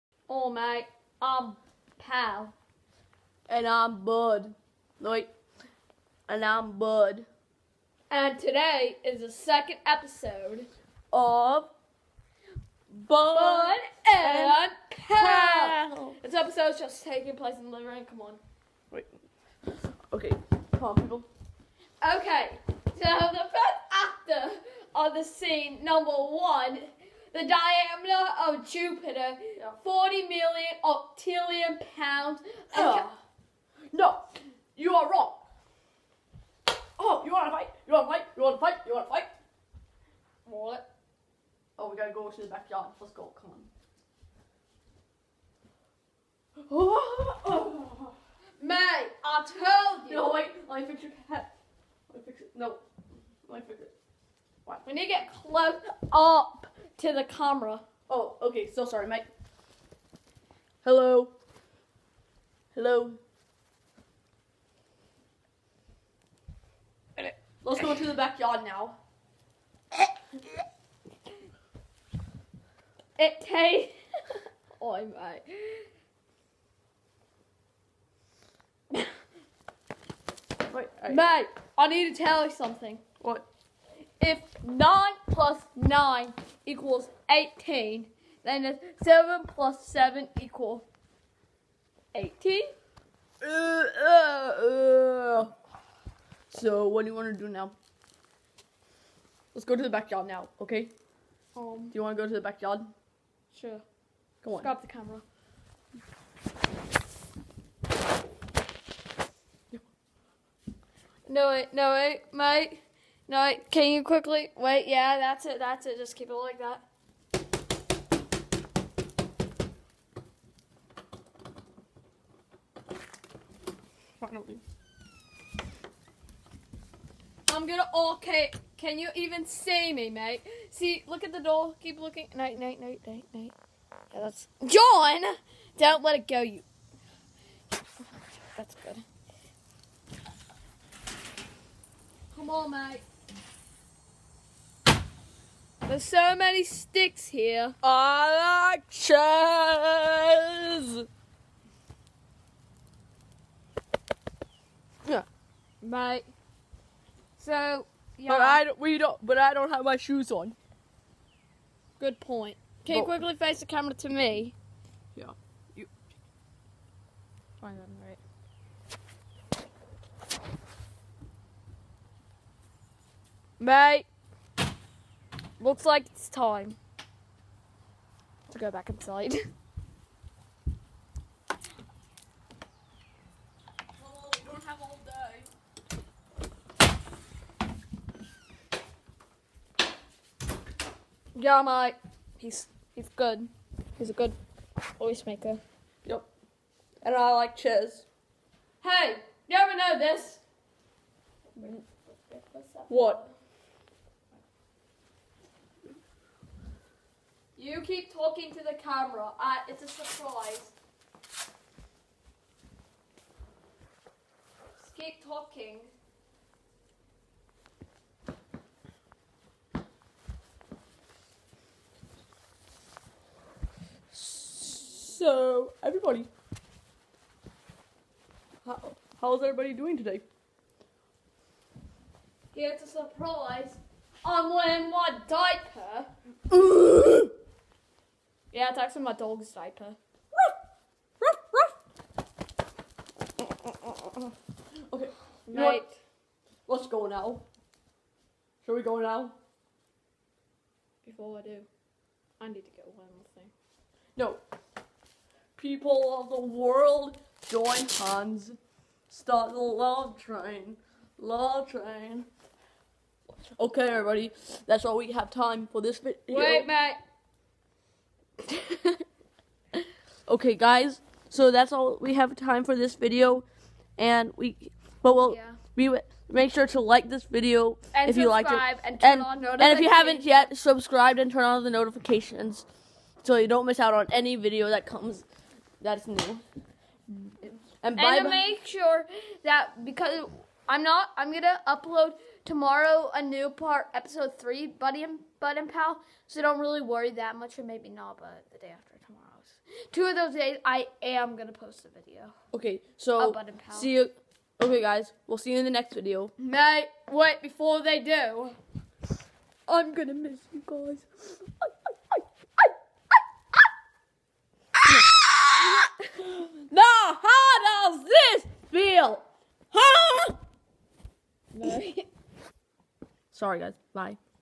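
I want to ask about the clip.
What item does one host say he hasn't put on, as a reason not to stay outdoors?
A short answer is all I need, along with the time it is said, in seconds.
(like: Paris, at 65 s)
shoes, at 159 s.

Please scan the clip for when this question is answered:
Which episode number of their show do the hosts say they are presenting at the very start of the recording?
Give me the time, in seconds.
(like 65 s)
9 s.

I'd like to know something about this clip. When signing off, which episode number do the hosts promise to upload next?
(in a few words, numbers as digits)
3.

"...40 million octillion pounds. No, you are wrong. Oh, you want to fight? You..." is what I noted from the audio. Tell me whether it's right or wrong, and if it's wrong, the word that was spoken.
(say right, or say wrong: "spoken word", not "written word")
right.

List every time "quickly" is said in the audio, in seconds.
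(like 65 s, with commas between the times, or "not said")
114 s, 163 s.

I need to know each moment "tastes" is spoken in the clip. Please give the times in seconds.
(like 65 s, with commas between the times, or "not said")
73 s.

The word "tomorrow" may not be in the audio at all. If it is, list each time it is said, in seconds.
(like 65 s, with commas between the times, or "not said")
292 s, 299 s.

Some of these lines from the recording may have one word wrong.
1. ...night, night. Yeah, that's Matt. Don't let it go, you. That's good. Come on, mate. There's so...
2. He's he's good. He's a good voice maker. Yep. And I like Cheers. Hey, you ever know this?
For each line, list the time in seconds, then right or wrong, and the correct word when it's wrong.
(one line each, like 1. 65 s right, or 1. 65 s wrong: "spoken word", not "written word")
1. 133 s wrong: "John", not "Matt"
2. 192 s right.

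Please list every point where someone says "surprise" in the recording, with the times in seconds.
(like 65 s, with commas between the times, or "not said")
209 s, 232 s.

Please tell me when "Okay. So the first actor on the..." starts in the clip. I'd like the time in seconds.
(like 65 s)
22 s.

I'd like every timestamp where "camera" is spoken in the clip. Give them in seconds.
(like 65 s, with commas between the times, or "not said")
57 s, 104 s, 163 s, 208 s.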